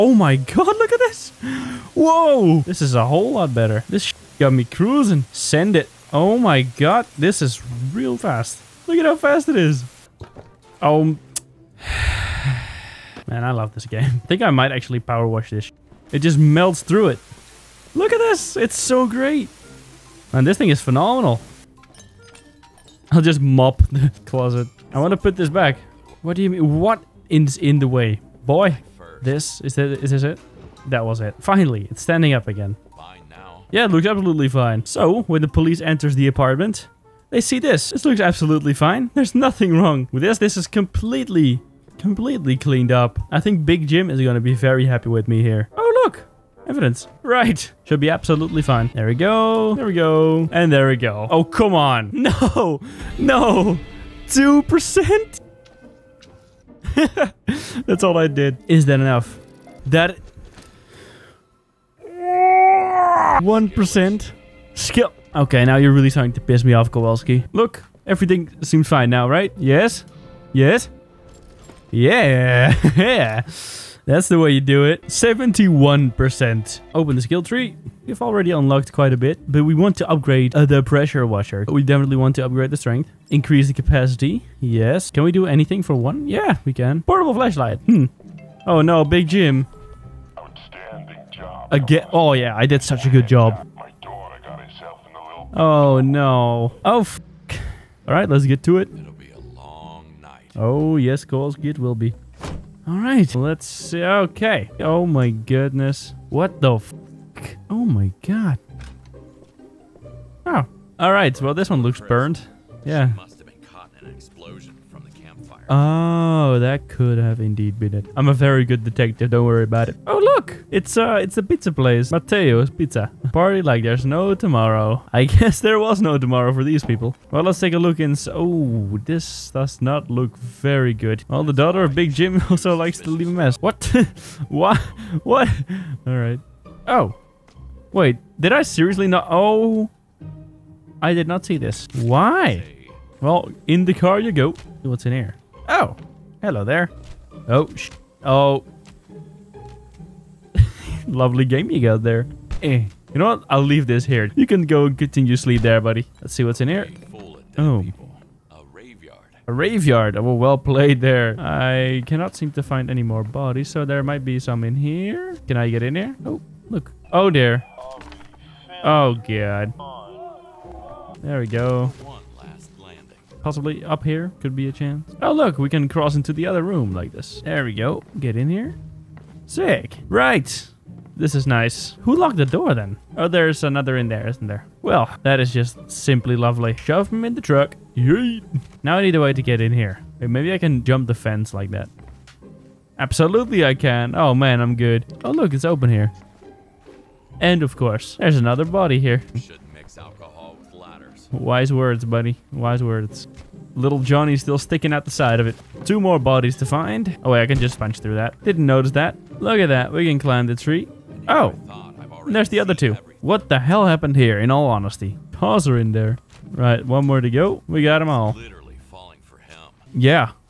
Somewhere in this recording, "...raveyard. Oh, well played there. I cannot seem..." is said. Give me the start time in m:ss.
2:39.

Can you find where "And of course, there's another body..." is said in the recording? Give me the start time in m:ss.
3:17.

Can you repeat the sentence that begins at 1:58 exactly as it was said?
I'm a very good detective, don't worry about it.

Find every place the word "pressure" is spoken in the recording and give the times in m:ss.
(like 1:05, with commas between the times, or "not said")
1:20.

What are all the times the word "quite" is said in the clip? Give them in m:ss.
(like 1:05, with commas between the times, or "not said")
1:18.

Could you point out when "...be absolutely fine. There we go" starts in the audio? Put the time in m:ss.
0:48.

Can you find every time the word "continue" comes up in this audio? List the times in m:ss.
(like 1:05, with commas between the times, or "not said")
2:34.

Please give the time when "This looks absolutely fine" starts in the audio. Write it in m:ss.
0:37.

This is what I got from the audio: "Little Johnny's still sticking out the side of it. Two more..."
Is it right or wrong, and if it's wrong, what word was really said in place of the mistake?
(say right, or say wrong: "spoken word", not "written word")
right.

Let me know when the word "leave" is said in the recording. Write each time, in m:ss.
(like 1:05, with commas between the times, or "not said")
2:13, 2:33.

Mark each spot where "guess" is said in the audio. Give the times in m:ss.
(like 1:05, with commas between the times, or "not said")
2:05.